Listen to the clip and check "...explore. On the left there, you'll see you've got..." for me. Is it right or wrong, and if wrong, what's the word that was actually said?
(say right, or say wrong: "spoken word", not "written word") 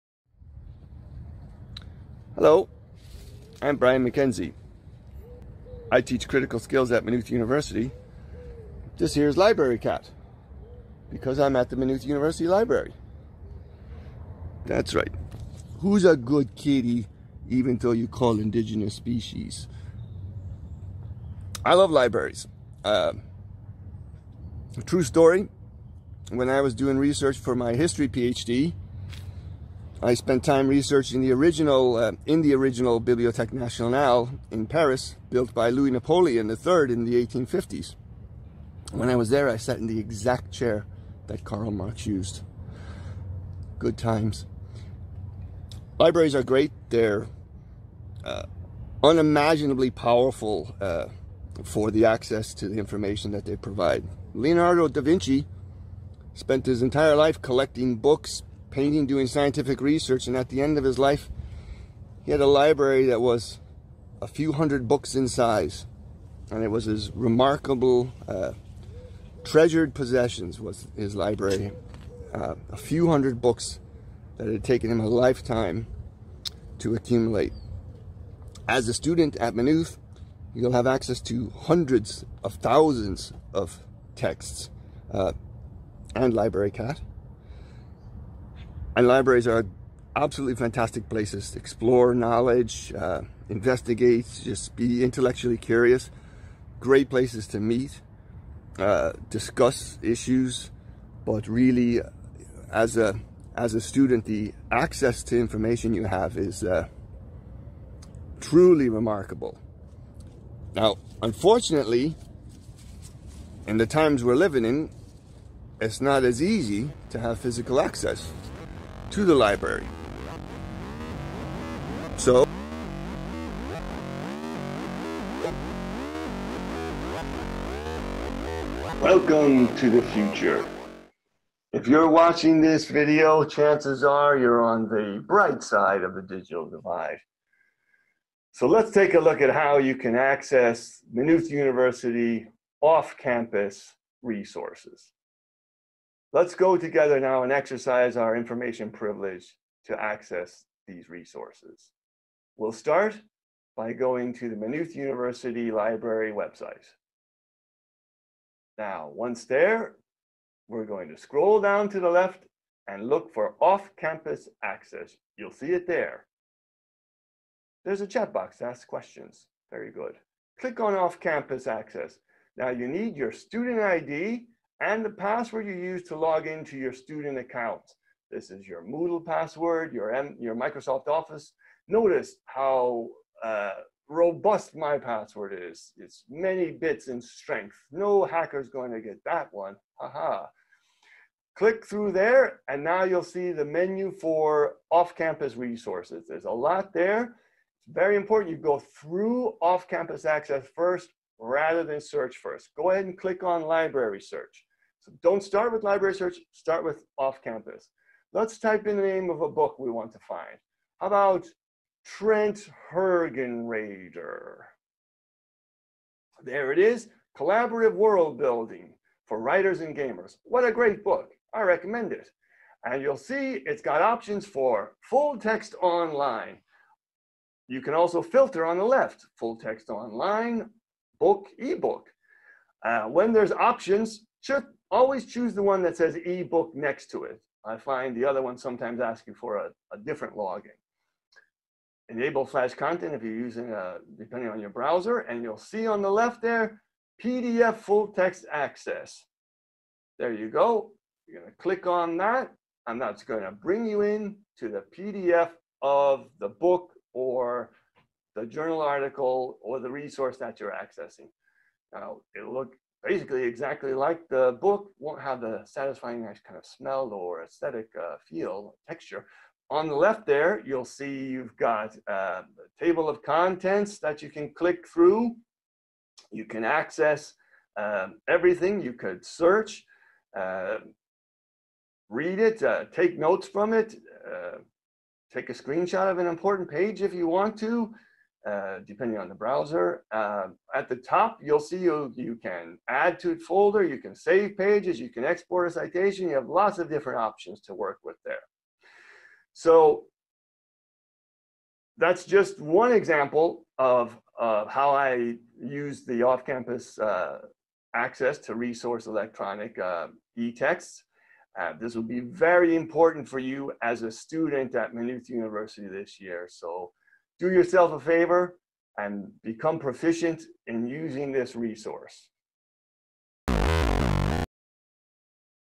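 wrong: "texture", not "explore".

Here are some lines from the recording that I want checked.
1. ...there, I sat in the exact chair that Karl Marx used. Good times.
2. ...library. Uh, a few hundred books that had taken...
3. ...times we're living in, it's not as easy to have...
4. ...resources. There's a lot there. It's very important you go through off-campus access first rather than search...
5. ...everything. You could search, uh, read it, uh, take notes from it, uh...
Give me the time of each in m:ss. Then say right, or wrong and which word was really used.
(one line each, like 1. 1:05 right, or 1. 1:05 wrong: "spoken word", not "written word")
1. 0:39 right
2. 1:11 right
3. 1:53 right
4. 3:15 right
5. 4:38 right.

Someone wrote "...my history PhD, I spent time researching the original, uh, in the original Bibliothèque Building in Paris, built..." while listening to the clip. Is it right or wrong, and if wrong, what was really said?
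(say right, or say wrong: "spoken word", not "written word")
wrong: "Nationale", not "Building".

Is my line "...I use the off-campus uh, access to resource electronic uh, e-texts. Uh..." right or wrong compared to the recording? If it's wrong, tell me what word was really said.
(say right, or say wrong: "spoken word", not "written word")
right.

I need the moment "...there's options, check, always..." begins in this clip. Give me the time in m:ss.
3:53.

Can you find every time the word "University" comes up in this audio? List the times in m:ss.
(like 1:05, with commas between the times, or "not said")
0:07, 0:12, 2:21, 2:34, 5:15.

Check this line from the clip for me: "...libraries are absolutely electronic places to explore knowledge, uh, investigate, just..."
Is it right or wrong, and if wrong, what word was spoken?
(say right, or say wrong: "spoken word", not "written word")
wrong: "fantastic", not "electronic".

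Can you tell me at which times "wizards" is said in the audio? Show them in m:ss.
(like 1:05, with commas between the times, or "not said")
not said.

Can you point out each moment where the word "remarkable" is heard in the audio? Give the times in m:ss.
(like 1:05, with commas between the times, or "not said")
1:07, 1:48.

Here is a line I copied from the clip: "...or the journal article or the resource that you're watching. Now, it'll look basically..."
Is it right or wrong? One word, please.
wrong.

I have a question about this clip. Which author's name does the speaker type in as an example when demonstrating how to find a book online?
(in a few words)
Trent Hergenrader.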